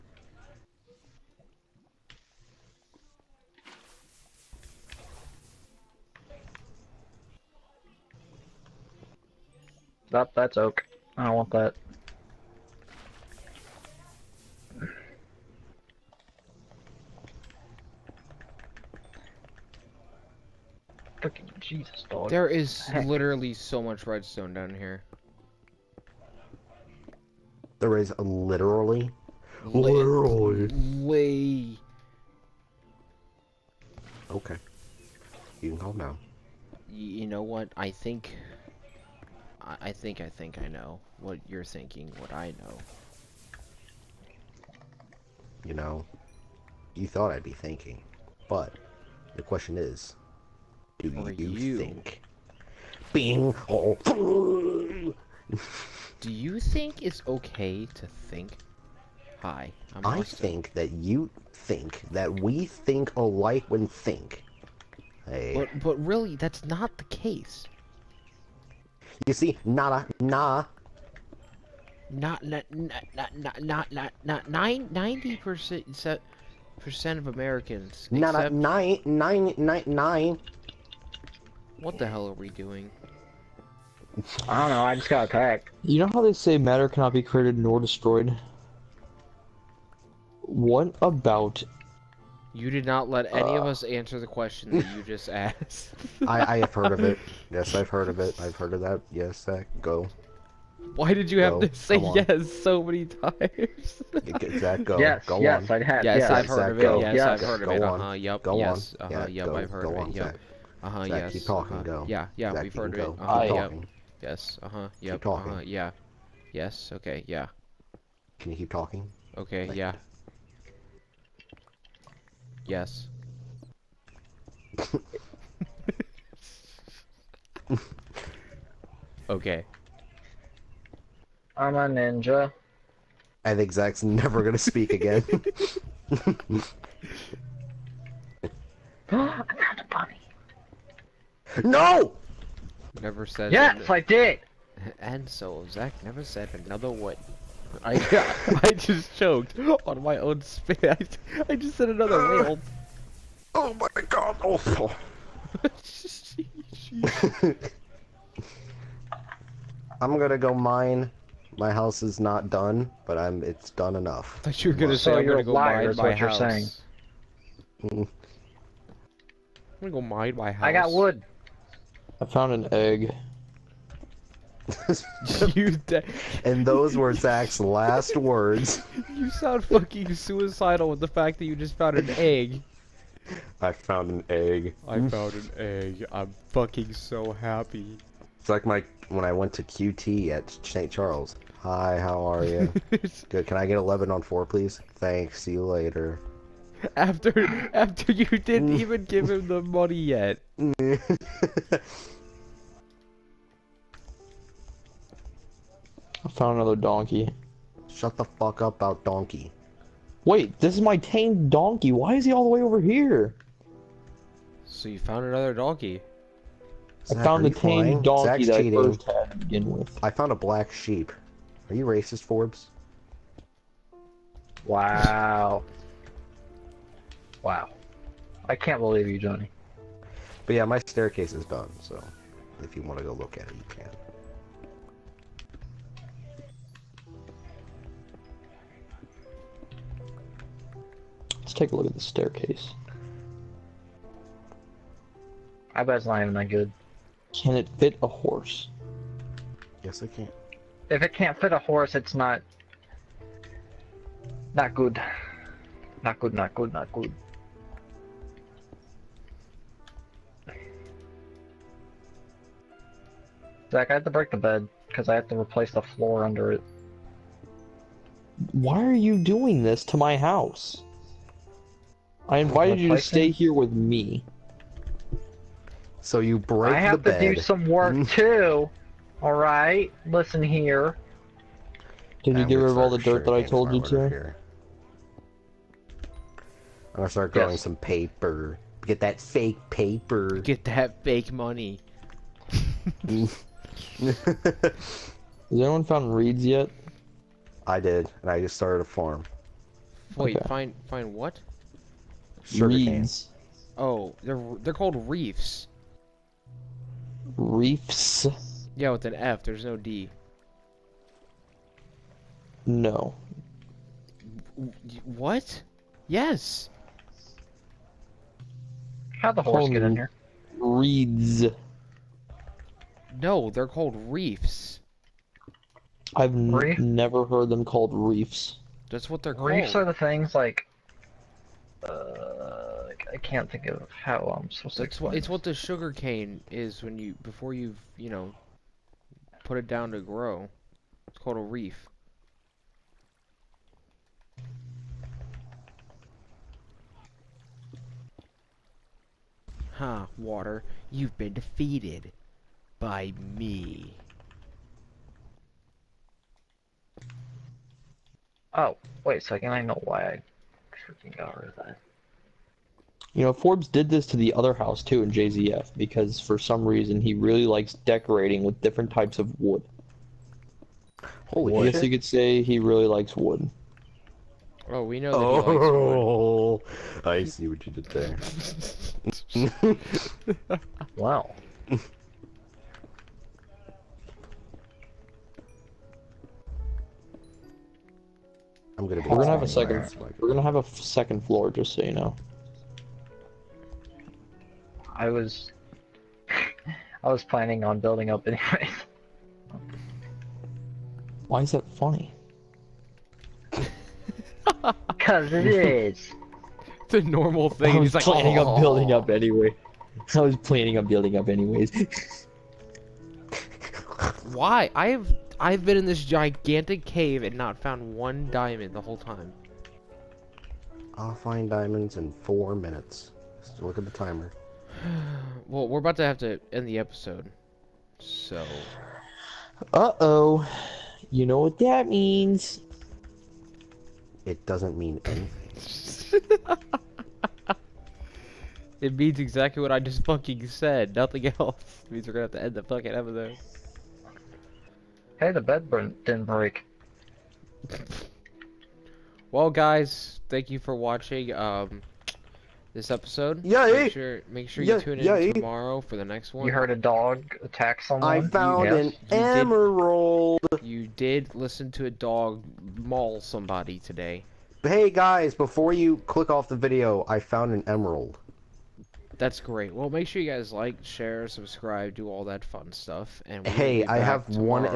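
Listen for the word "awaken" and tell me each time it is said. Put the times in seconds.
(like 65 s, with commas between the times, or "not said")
not said.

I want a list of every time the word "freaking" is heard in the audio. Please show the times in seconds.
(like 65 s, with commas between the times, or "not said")
21 s, 360 s.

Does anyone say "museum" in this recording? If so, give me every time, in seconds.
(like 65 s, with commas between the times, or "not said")
not said.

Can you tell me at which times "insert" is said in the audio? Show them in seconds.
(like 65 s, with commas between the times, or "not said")
not said.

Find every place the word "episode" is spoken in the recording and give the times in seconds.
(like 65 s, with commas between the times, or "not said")
426 s, 442 s, 452 s.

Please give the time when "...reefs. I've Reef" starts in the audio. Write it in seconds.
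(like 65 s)
324 s.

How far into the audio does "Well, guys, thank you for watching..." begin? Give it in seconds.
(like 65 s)
449 s.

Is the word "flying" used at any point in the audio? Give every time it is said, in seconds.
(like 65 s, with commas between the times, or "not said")
217 s.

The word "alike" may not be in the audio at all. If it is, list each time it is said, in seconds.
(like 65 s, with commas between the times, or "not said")
63 s.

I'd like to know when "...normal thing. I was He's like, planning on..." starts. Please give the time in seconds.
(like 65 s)
407 s.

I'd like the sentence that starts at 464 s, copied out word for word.
Hey guys, before you click off the video, I found an emerald.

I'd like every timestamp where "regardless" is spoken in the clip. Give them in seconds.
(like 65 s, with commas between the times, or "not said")
not said.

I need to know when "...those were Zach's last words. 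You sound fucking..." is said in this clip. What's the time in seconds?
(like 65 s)
176 s.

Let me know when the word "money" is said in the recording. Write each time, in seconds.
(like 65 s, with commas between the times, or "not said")
199 s, 291 s.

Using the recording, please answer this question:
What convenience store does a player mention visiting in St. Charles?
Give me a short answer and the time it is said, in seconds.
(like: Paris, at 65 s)
QT, at 189 s.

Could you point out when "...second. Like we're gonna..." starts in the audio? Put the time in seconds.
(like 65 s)
389 s.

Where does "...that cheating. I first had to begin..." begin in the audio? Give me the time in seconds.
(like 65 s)
218 s.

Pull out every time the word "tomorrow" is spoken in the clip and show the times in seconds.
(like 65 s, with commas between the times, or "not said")
455 s, 474 s.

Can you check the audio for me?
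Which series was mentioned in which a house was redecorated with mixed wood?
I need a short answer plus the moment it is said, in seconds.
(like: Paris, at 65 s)
JZF, at 365 s.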